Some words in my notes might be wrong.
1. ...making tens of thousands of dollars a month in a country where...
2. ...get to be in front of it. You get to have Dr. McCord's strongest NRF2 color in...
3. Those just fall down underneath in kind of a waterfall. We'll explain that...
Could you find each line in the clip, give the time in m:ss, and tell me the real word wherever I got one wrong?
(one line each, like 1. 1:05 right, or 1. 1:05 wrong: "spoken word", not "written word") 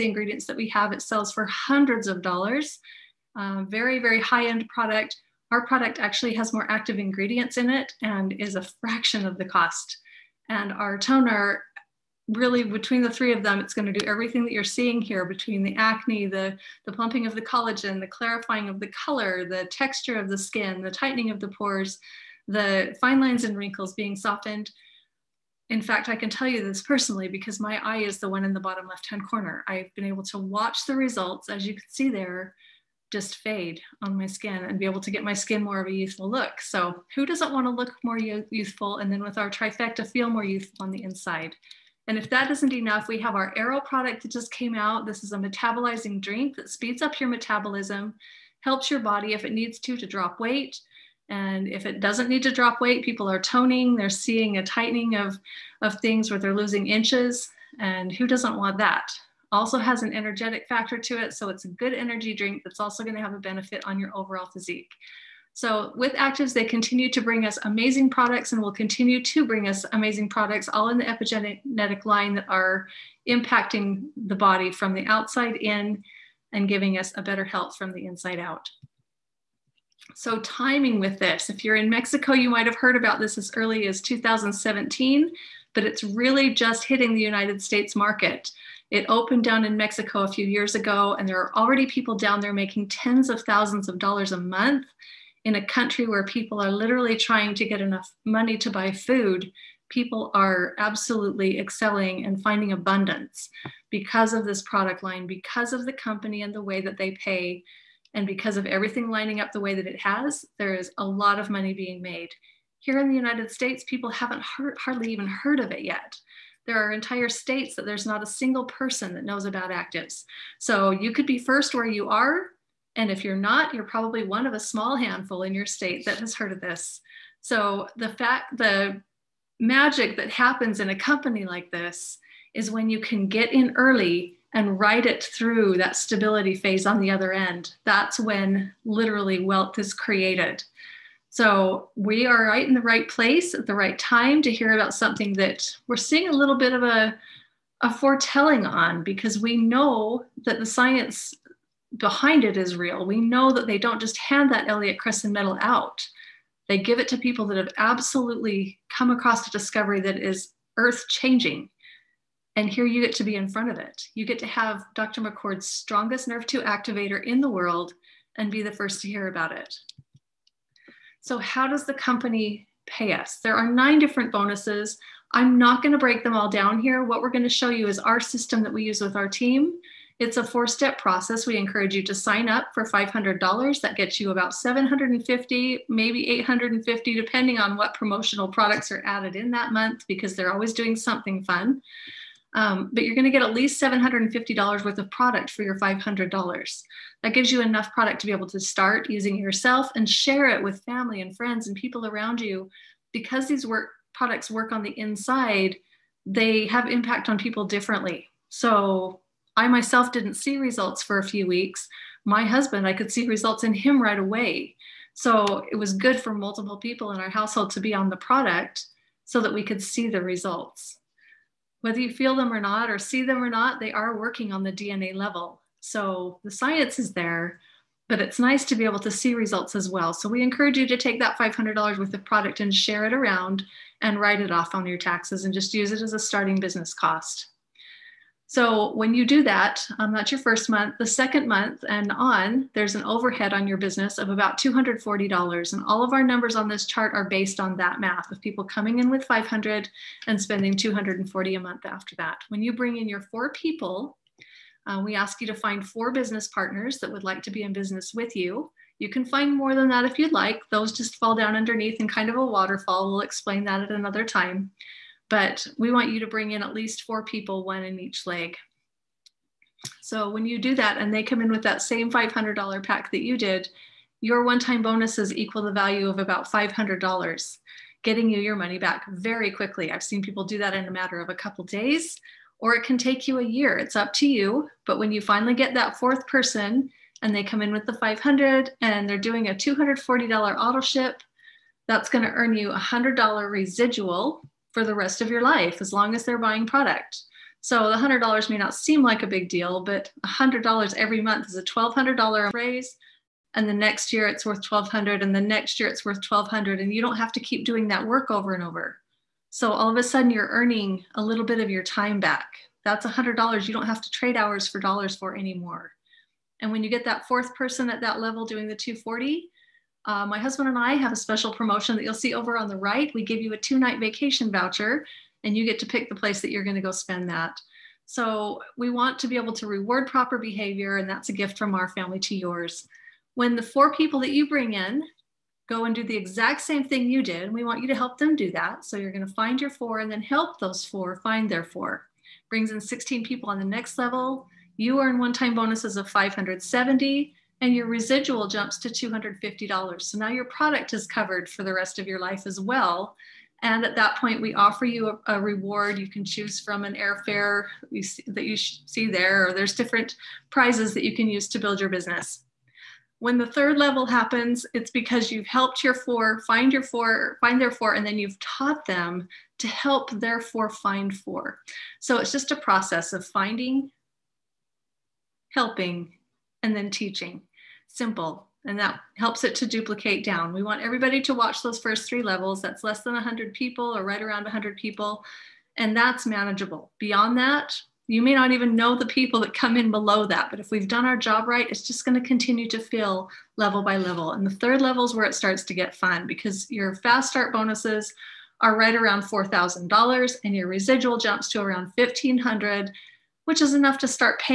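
1. 1:32 right
2. 2:43 wrong: "activator", not "color"
3. 4:20 right.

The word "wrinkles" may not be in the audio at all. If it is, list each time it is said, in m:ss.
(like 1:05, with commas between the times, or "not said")
0:23.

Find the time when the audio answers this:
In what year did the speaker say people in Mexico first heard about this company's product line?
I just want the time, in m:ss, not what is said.
1:24.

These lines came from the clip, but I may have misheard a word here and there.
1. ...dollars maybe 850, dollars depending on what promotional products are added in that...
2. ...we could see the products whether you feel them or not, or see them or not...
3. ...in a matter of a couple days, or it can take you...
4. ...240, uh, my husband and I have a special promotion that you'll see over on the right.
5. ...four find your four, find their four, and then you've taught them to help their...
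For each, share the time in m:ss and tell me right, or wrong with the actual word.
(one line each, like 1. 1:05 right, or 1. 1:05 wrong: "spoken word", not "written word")
1. 3:05 right
2. 3:39 wrong: "results", not "products"
3. 4:40 right
4. 5:18 right
5. 6:05 right.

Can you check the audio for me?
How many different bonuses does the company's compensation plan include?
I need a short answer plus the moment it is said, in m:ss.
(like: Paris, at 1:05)
9, at 2:53.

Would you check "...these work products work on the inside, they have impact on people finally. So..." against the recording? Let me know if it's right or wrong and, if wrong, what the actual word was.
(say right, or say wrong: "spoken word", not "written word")
wrong: "differently", not "finally".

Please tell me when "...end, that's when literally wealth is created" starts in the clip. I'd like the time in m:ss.
2:17.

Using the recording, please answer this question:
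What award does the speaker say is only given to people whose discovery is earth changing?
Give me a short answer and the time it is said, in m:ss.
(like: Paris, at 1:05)
Elliott Cresson medal, at 2:34.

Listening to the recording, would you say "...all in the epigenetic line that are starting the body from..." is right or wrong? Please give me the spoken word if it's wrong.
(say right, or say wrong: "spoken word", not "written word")
wrong: "impacting", not "starting".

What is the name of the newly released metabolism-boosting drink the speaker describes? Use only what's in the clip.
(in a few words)
Aero.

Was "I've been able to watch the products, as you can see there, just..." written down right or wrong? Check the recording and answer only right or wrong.
wrong.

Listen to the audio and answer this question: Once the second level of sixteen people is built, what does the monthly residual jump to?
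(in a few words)
$250.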